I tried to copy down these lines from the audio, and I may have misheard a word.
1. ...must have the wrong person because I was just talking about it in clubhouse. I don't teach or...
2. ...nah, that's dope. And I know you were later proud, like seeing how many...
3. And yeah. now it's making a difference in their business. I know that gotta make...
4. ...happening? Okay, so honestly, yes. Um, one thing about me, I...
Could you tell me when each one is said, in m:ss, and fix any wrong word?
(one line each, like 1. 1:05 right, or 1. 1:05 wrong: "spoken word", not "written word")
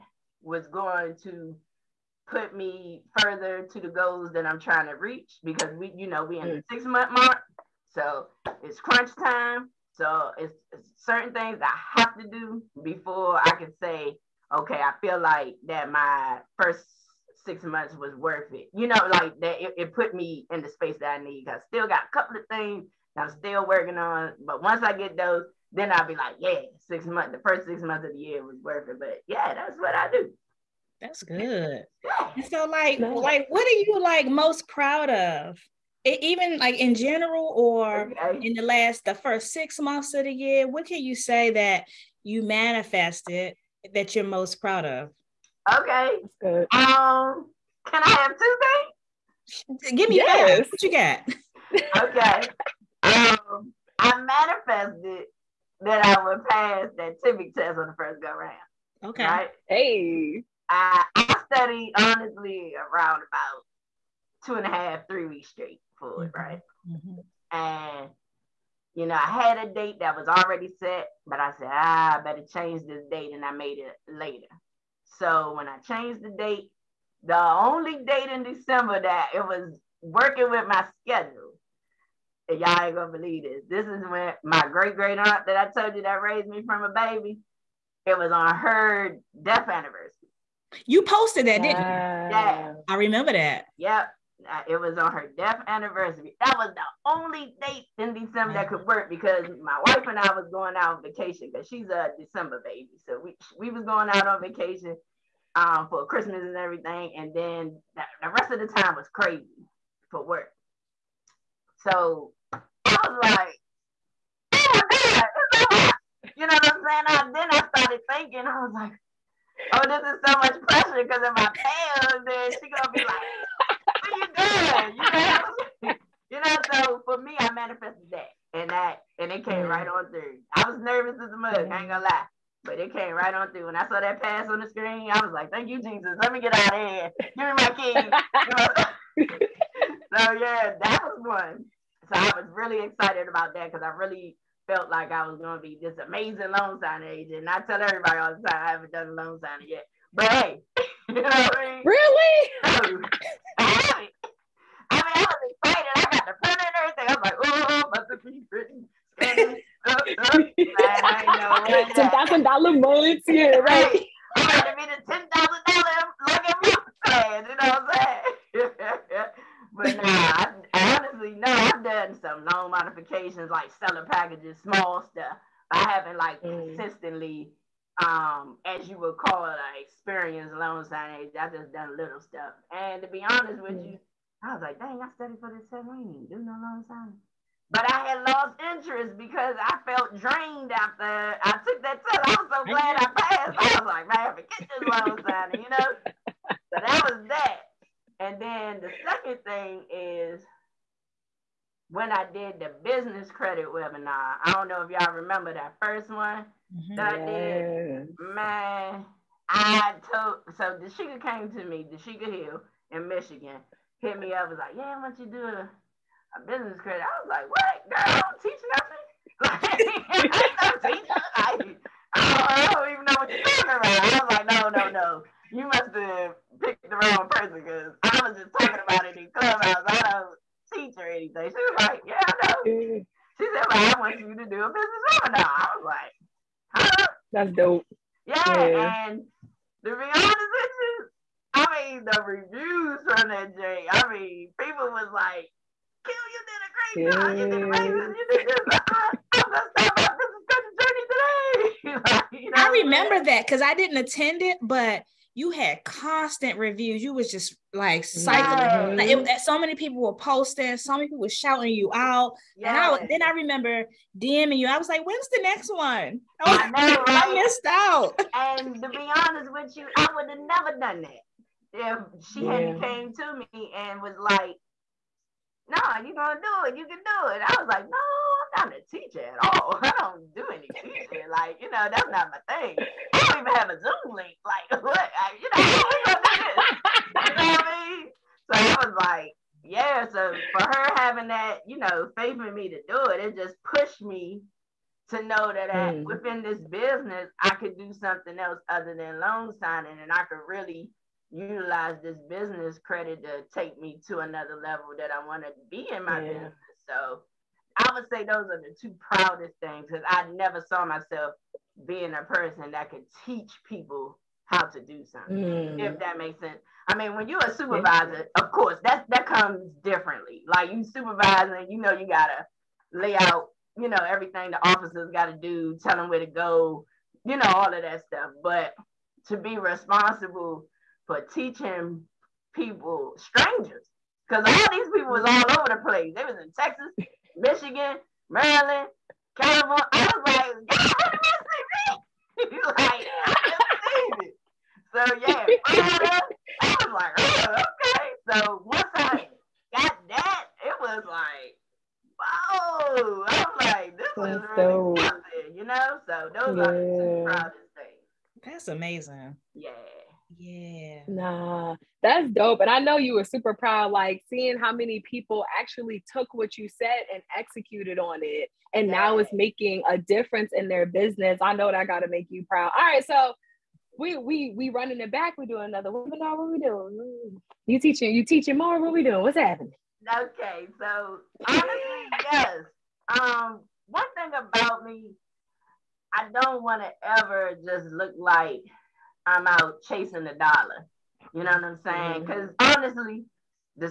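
1. 3:45 right
2. 6:01 wrong: "super", not "later"
3. 6:08 right
4. 6:19 right.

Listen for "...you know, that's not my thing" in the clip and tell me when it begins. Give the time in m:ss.
4:41.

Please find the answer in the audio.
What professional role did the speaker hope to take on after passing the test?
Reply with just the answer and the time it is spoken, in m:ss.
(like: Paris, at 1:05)
Loan signing agent, at 2:26.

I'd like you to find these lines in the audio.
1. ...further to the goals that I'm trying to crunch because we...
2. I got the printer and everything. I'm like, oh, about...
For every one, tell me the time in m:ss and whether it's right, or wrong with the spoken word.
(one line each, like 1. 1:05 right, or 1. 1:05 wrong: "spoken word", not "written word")
1. 0:03 wrong: "reach", not "crunch"
2. 2:35 right.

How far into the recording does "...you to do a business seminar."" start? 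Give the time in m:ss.
3:54.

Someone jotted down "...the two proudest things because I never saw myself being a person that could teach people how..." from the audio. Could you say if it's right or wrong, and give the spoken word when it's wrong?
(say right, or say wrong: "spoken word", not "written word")
right.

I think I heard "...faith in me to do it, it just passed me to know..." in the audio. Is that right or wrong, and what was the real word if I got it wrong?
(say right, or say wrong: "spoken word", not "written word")
wrong: "pushed", not "passed".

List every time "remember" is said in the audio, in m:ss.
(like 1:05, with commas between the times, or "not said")
1:32, 3:25, 4:12, 4:23.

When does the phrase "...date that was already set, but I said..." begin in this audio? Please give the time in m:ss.
1:09.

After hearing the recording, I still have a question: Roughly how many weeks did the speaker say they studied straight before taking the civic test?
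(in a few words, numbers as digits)
2.5 to 3 weeks.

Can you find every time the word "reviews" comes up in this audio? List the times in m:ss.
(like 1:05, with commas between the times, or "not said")
4:02, 4:16.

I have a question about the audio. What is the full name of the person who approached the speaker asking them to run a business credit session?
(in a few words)
Dashika Hill.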